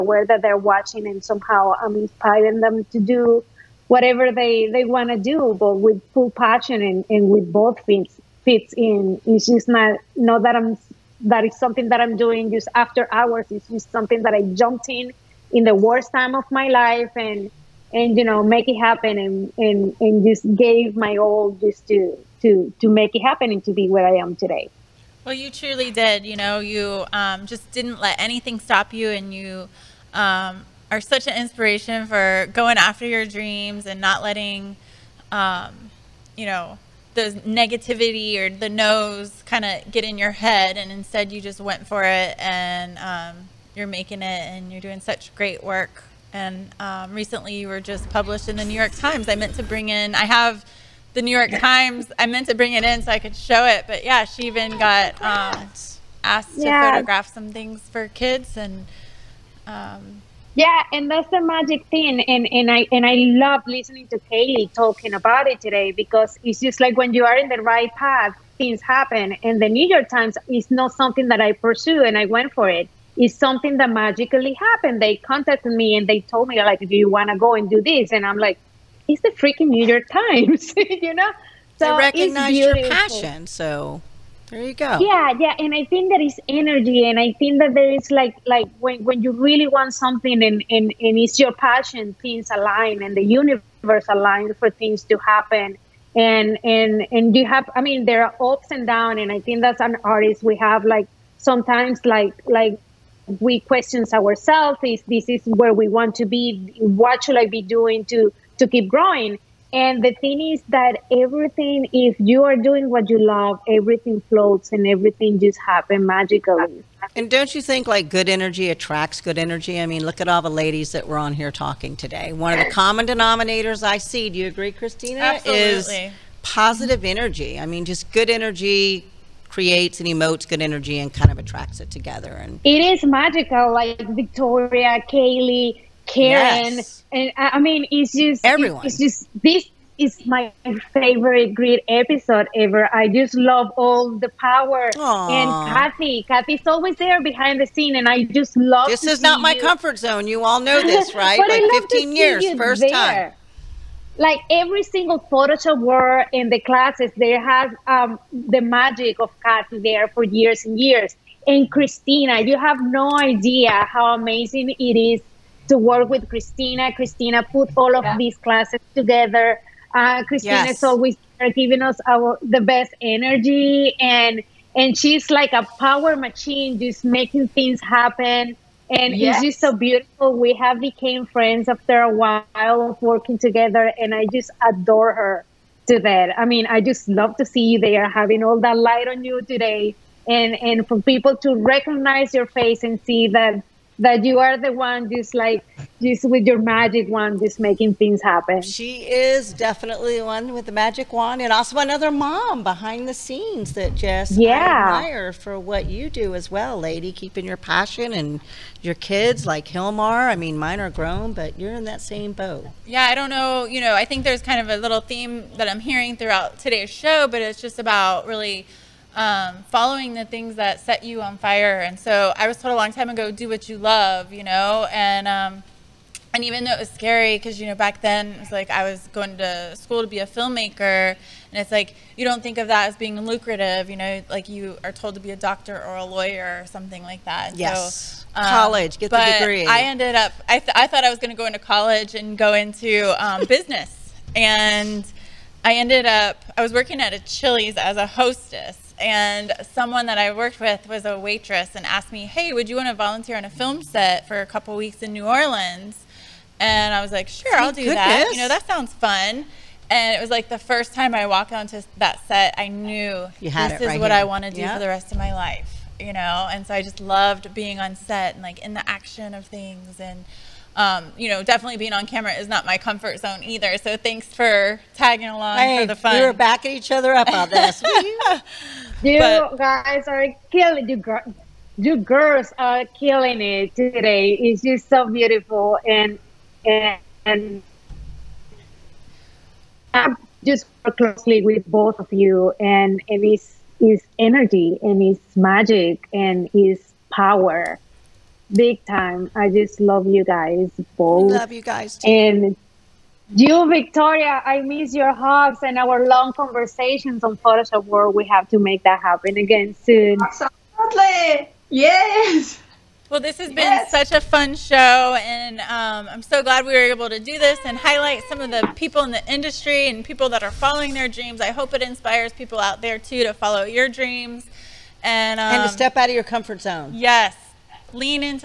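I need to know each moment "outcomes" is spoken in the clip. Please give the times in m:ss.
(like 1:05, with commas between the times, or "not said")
not said.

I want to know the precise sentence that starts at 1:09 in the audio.
And the New York Times is not something that I pursue, and I went for it.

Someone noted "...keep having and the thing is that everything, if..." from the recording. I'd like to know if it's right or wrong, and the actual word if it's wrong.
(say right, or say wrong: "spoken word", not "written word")
wrong: "growing", not "having".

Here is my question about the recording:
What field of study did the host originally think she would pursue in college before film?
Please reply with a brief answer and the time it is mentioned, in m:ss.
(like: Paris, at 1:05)
business, at 4:03.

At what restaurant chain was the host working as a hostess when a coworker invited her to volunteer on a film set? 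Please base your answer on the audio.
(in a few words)
Chili's.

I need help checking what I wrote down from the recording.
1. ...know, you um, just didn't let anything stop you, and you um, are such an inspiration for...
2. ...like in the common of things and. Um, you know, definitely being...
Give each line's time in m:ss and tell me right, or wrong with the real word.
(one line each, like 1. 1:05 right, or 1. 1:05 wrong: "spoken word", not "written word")
1. 0:26 right
2. 4:28 wrong: "action", not "common".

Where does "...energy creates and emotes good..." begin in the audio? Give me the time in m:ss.
2:08.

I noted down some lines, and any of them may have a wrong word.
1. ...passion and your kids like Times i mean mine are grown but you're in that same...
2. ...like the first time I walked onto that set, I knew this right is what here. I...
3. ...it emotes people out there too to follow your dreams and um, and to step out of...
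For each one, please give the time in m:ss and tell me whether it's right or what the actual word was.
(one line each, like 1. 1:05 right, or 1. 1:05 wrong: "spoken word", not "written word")
1. 3:27 wrong: "Gilmar", not "Times"
2. 4:20 right
3. 5:21 wrong: "inspires", not "emotes".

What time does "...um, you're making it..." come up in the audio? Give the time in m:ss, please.
0:42.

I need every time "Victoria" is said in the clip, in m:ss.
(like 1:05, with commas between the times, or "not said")
2:13, 5:03.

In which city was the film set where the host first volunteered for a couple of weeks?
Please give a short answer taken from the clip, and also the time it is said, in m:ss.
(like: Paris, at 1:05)
New Orleans, at 4:15.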